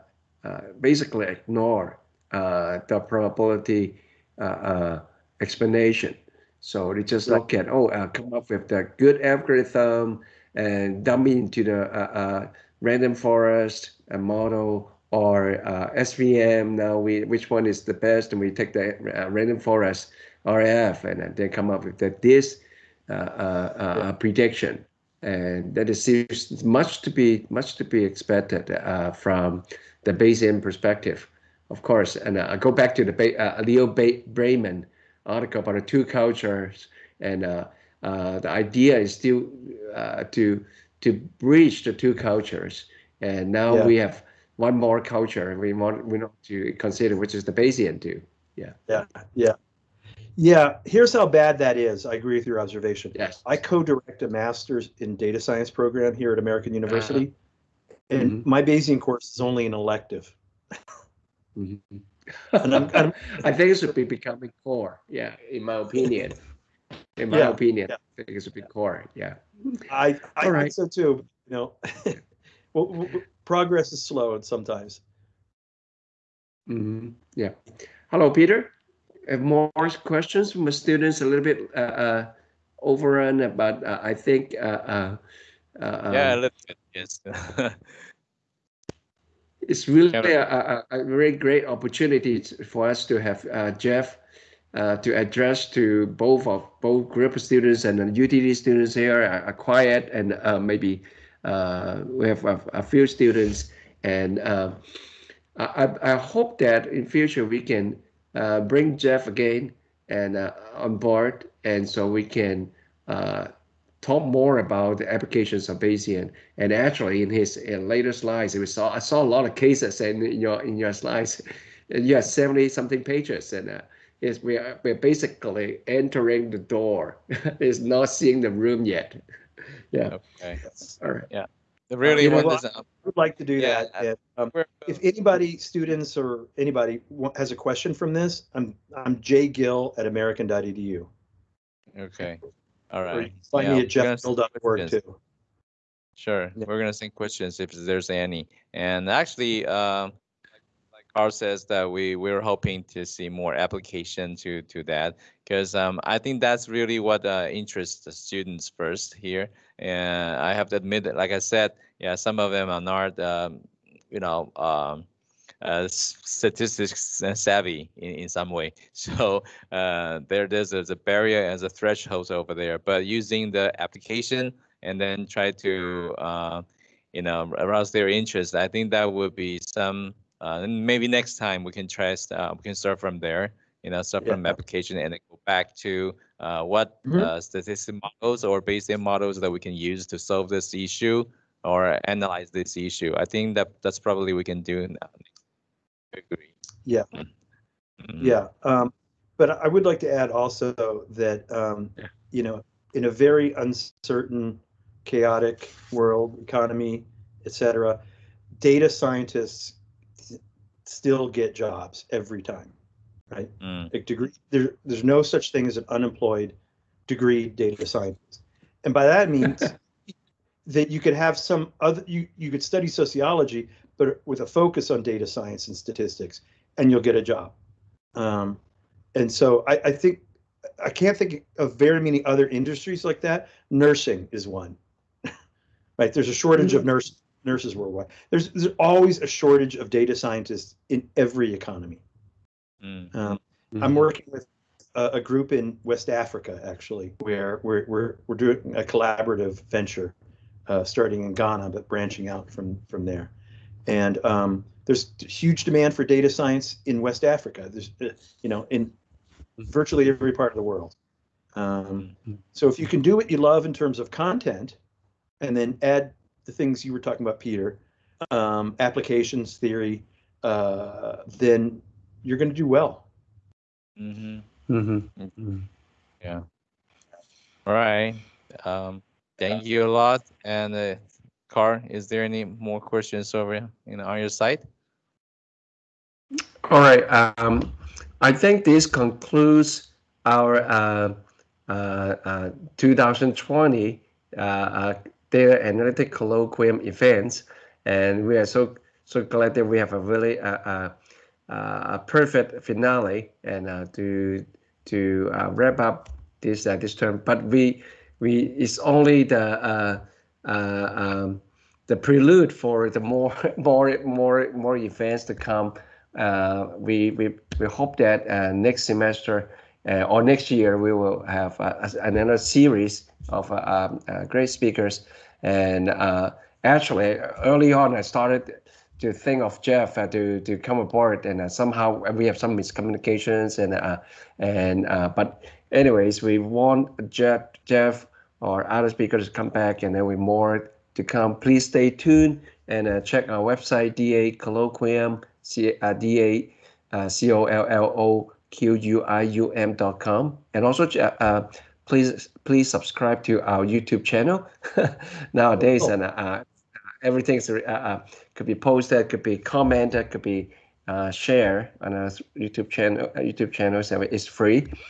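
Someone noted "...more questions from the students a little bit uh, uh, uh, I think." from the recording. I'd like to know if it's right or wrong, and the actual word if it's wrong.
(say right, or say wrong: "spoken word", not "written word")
right.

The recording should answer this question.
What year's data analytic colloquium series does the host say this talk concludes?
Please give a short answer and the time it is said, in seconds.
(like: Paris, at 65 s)
2020, at 292 s.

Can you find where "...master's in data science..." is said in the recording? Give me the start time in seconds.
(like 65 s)
54 s.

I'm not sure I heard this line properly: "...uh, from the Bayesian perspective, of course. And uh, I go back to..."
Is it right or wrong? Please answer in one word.
right.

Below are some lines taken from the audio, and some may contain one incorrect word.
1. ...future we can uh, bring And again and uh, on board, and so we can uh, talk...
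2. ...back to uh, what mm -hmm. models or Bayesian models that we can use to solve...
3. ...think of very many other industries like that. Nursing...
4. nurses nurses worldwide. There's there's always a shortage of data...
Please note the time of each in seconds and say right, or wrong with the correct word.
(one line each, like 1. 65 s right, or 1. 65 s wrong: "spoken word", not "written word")
1. 107 s wrong: "Jeff", not "And"
2. 185 s right
3. 231 s right
4. 236 s right.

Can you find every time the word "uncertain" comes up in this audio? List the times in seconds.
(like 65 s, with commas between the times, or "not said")
203 s.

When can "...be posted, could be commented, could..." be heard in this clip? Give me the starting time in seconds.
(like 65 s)
358 s.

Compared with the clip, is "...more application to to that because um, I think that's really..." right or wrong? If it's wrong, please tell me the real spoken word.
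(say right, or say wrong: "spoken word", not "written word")
right.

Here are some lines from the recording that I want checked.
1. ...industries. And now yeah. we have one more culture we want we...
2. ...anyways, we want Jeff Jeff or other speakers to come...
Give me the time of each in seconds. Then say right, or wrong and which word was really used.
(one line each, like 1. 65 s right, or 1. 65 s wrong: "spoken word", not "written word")
1. 42 s wrong: "cultures", not "industries"
2. 335 s right.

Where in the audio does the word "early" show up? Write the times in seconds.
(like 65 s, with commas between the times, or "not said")
327 s.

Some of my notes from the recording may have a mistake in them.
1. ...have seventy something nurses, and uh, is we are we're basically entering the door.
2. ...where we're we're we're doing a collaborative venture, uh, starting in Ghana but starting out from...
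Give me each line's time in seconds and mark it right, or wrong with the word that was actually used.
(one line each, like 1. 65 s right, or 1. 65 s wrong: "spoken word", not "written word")
1. 122 s wrong: "pages", not "nurses"
2. 247 s wrong: "branching", not "starting".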